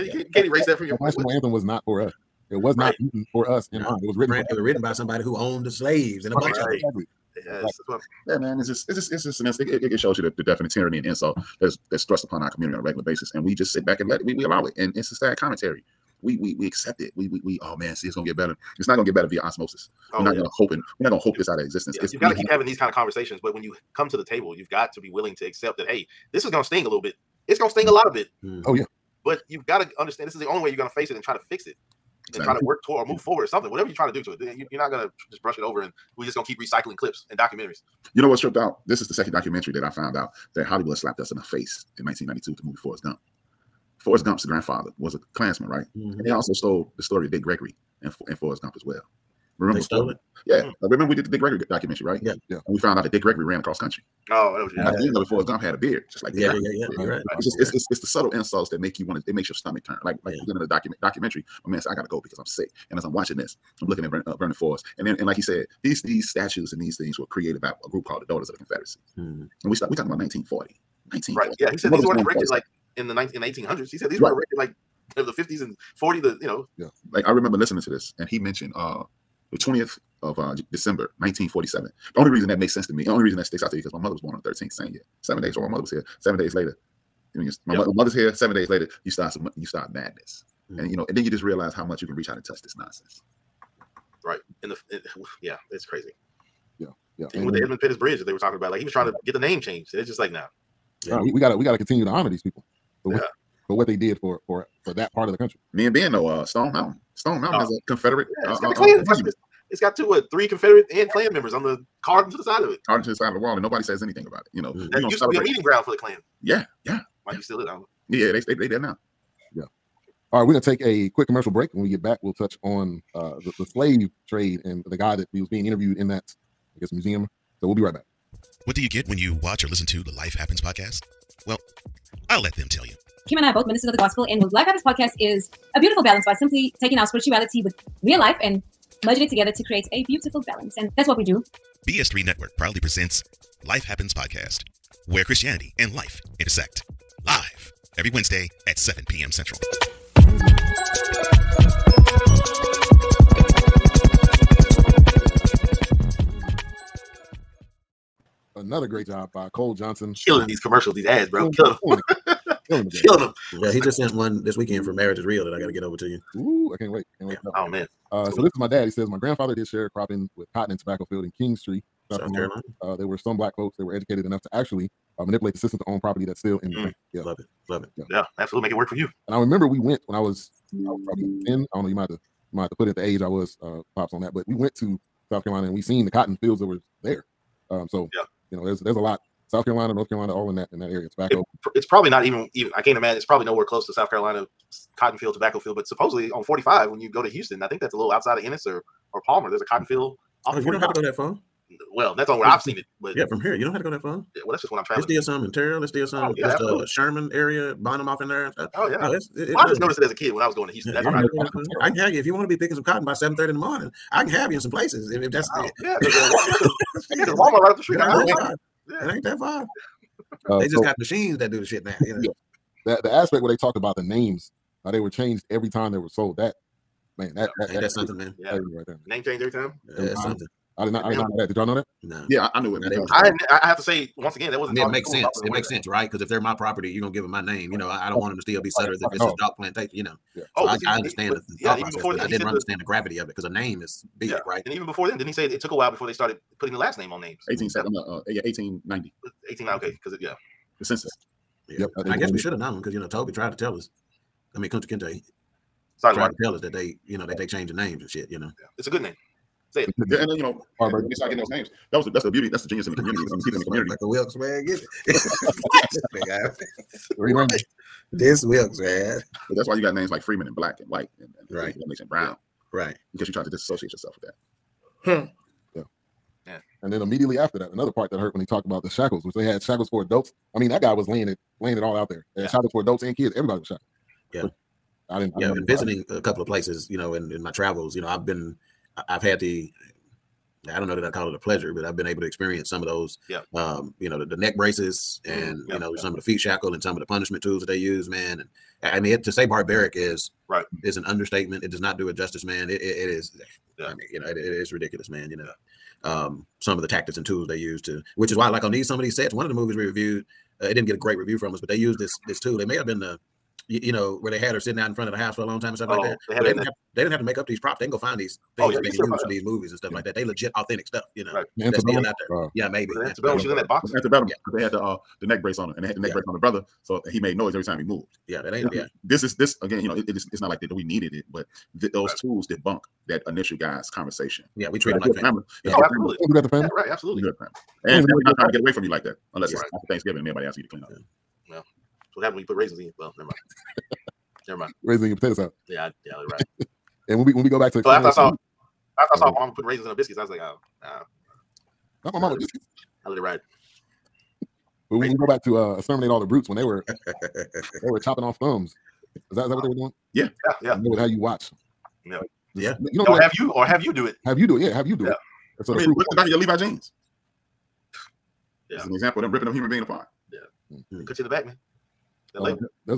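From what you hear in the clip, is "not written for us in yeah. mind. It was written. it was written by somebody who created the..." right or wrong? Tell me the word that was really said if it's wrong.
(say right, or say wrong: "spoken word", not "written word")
wrong: "owned", not "created".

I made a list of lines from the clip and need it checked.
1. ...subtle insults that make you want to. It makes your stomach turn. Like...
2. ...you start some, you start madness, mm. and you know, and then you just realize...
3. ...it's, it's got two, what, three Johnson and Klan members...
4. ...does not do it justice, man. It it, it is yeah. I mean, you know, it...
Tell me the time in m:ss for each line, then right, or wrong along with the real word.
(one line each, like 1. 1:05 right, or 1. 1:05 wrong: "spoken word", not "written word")
1. 0:58 right
2. 1:29 right
3. 1:49 wrong: "Confederate", not "Johnson"
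4. 5:01 right.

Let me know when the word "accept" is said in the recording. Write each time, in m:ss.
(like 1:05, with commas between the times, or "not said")
0:16, 0:25.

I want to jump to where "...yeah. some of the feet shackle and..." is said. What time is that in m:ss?
4:55.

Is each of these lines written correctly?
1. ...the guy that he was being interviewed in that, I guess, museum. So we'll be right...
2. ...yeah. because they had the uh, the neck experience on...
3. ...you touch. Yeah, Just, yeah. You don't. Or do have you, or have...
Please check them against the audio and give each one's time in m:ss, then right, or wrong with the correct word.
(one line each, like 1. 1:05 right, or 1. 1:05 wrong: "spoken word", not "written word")
1. 2:04 right
2. 5:24 wrong: "brace", not "experience"
3. 6:01 wrong: "watch", not "touch".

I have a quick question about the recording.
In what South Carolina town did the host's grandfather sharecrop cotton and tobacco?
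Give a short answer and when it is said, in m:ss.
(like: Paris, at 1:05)
Kingstree, at 2:51.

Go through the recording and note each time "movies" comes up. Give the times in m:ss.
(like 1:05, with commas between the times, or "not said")
0:42, 5:09, 5:19.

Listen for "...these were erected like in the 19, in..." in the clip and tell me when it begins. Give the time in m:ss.
1:11.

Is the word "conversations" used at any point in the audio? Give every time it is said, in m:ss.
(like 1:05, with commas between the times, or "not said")
0:22, 5:33.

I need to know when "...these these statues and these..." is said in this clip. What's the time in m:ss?
1:05.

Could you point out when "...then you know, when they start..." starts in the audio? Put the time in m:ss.
4:20.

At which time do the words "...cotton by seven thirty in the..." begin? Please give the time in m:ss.
3:32.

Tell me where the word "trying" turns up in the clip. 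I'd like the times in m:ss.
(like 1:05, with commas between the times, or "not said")
0:33, 1:38, 5:38.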